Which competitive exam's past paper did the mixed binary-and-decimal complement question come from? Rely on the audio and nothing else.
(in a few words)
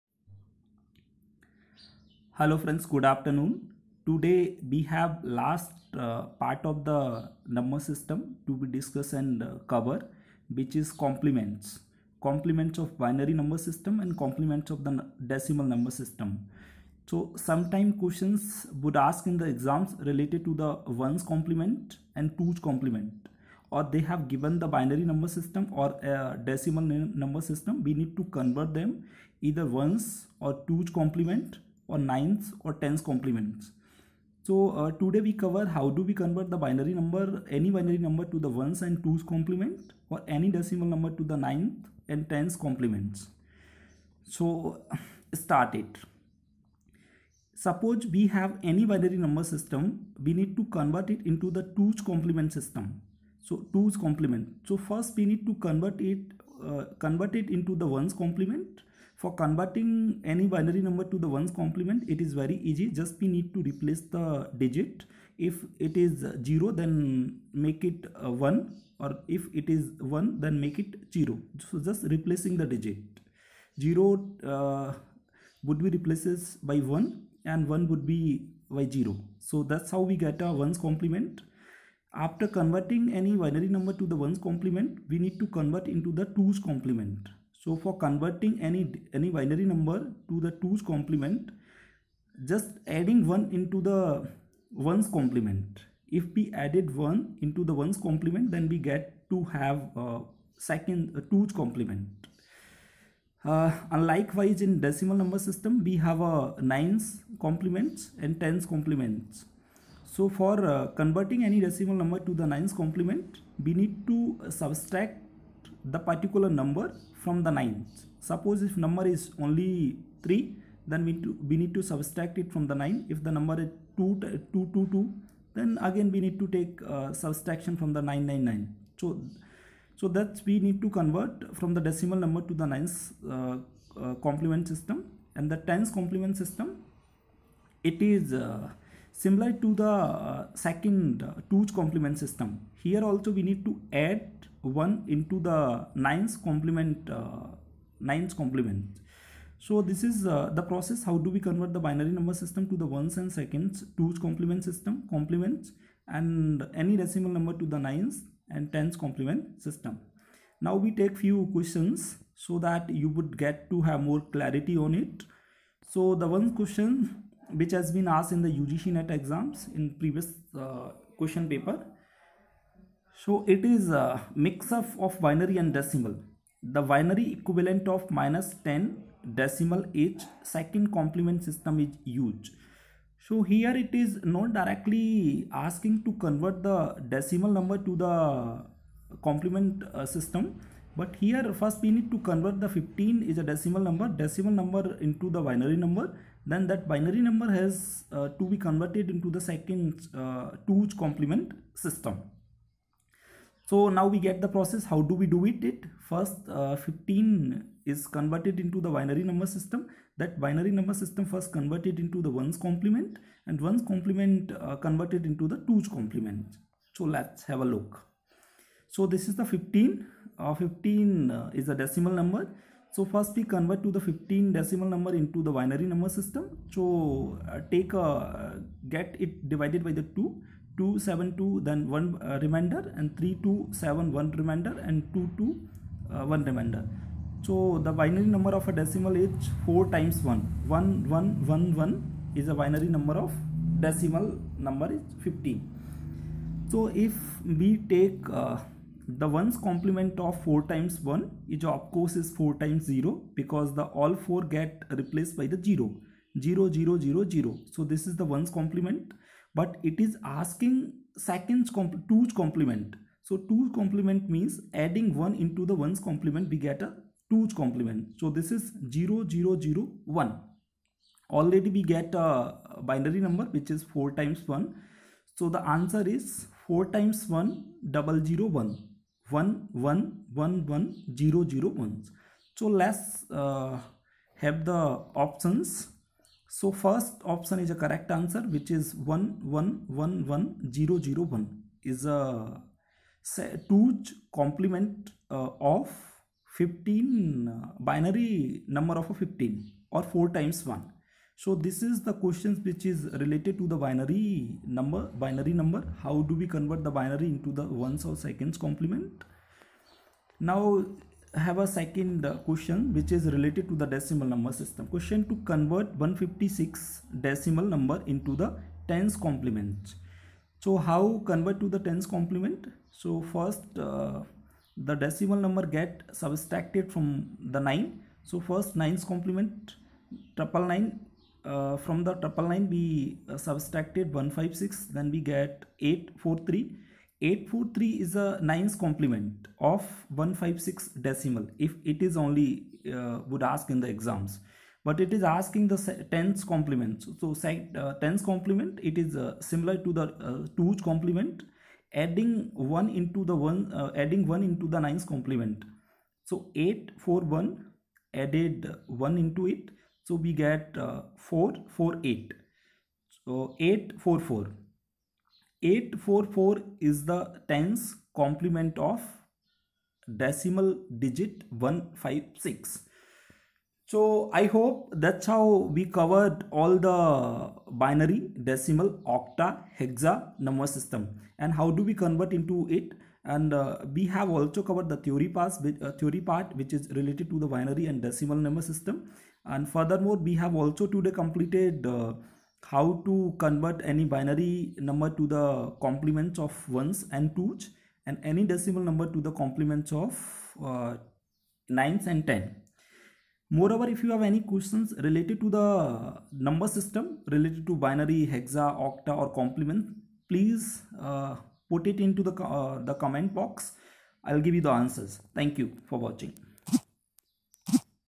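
UGC NET.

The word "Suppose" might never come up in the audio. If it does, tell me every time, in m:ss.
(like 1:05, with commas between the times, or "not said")
0:47, 1:58.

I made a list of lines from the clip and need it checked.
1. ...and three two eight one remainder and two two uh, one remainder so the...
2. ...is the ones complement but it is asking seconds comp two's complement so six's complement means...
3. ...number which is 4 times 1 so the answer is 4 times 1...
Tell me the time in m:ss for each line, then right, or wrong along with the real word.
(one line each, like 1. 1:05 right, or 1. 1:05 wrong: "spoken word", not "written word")
1. 3:52 wrong: "seven", not "eight"
2. 4:18 wrong: "two", not "six"
3. 4:33 right.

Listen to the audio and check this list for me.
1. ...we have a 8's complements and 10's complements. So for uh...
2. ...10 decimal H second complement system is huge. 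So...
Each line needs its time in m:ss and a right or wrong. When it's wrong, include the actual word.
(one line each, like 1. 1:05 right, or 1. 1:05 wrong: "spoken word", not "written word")
1. 1:45 wrong: "9", not "8"
2. 2:58 right.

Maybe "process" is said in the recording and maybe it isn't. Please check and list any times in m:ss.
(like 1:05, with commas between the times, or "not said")
2:30, 3:24.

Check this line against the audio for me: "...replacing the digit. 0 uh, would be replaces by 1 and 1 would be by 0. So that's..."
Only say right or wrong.
right.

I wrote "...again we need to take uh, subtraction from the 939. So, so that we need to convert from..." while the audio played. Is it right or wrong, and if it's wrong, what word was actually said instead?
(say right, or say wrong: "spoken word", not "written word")
wrong: "999", not "939".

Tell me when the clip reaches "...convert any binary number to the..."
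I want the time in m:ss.
6:33.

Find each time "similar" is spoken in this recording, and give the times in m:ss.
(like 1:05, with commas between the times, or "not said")
2:19, 5:49.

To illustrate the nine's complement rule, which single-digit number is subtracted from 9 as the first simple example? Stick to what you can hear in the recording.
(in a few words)
3.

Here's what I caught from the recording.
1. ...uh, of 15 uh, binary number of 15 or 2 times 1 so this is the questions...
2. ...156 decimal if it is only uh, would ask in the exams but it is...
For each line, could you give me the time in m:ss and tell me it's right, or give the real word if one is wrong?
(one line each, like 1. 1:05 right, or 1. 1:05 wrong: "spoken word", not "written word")
1. 4:55 wrong: "4", not "2"
2. 5:40 right.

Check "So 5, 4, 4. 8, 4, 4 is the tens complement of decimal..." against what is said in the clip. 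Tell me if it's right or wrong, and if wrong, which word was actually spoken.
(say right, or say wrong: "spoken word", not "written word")
wrong: "8", not "5".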